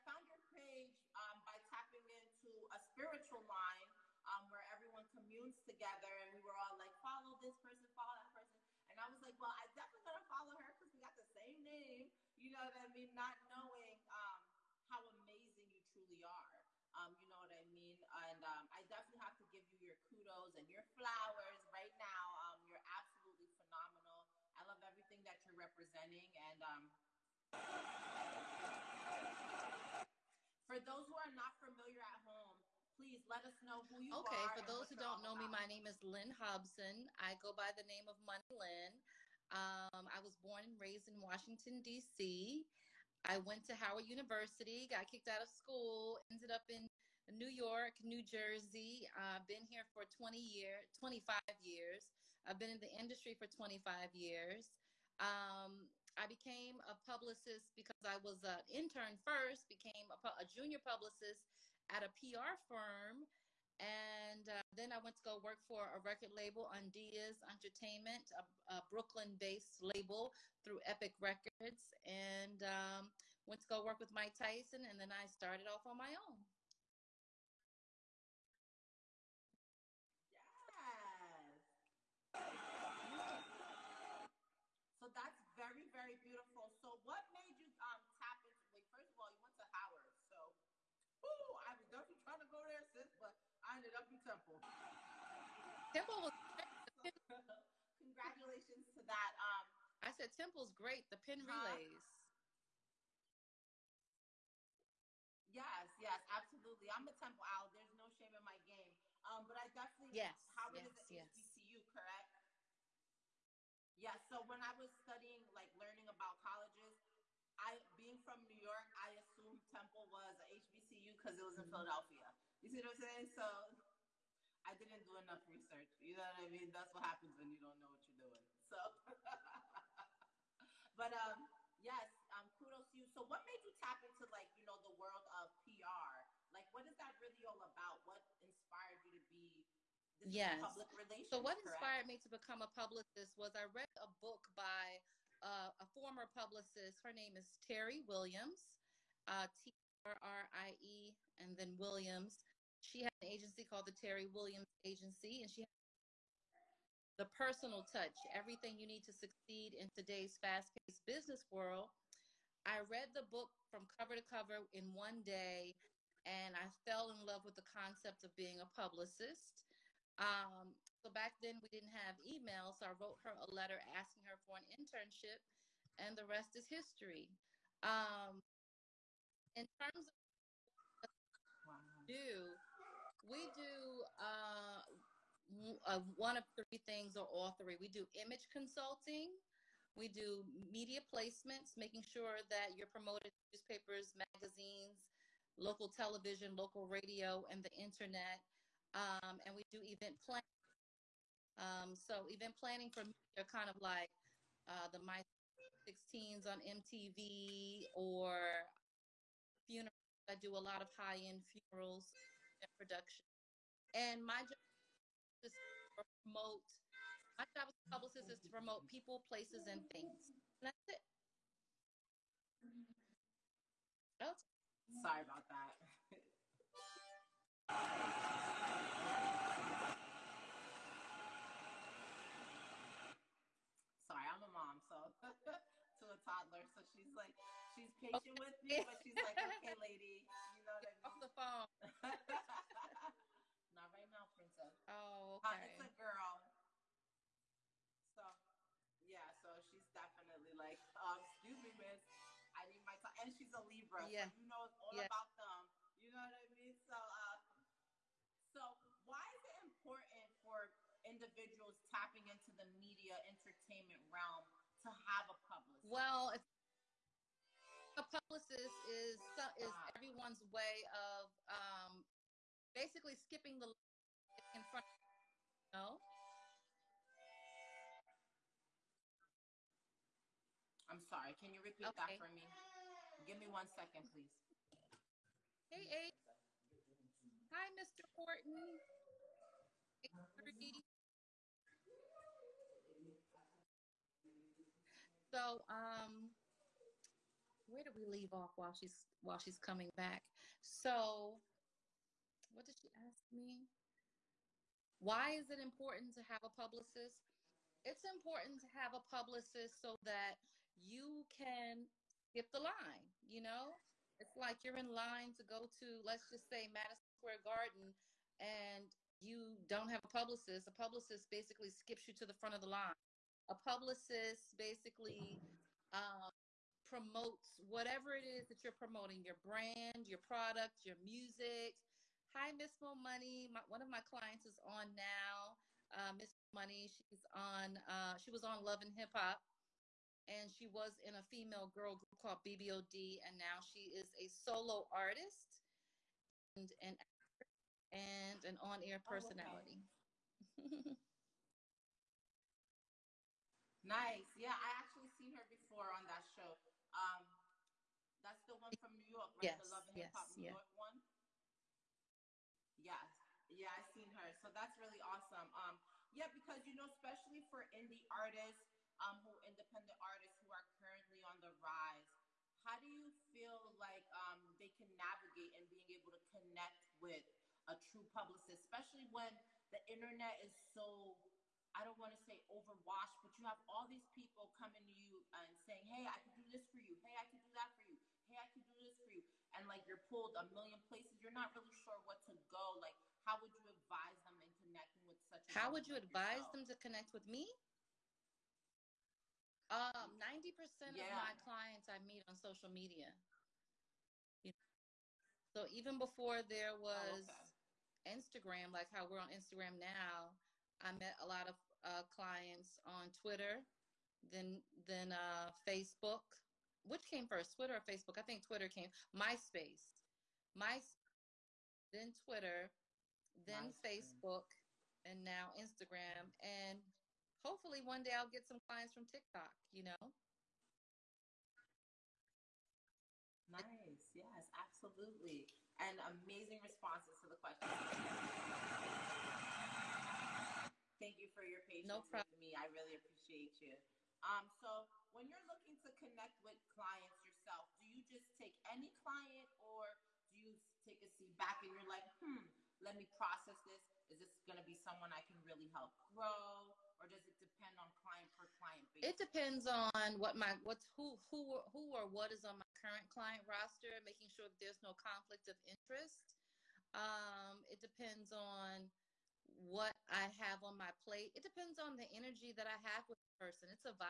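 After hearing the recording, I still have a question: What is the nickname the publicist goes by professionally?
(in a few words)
Money Lynn.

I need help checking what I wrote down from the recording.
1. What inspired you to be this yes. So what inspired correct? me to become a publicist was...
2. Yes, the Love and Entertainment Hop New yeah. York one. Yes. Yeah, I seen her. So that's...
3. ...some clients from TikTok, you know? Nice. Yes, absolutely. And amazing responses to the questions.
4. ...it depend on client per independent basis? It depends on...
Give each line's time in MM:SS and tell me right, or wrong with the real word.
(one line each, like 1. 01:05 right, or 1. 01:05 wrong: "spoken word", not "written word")
1. 02:18 right
2. 05:59 wrong: "Hip", not "Entertainment"
3. 07:08 right
4. 07:37 wrong: "client", not "independent".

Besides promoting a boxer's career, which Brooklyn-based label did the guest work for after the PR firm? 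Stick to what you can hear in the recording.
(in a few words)
Undeas Entertainment.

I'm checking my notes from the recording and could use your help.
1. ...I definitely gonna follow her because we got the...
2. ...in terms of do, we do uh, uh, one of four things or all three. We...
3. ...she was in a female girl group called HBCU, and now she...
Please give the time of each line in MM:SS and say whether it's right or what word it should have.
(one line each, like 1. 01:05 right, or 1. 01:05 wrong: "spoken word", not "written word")
1. 00:09 right
2. 02:59 wrong: "three", not "four"
3. 05:40 wrong: "BBOD", not "HBCU".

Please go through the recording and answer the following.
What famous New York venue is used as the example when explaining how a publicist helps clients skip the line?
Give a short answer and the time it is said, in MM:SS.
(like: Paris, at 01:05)
Madison Square Garden, at 05:16.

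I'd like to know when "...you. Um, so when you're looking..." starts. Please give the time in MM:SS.
07:23.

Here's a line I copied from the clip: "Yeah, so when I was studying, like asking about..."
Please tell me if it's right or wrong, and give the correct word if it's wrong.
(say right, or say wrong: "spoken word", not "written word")
wrong: "learning", not "asking".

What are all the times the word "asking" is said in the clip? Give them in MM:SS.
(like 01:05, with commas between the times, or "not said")
02:53.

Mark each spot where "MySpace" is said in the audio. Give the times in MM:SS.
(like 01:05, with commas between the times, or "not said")
06:59, 07:03.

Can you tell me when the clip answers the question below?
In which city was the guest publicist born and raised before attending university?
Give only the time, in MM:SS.
00:41.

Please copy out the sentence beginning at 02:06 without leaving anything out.
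That's what happens when you don't know what you're doing.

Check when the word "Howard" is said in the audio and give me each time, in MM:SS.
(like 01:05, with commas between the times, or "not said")
00:43, 01:29, 01:50.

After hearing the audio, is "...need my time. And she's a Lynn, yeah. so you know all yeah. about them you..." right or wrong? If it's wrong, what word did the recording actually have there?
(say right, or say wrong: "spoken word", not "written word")
wrong: "Libra", not "Lynn".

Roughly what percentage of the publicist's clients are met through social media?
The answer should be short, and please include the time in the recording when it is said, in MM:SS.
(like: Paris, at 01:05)
90%, at 06:40.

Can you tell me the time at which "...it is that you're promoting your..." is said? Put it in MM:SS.
05:28.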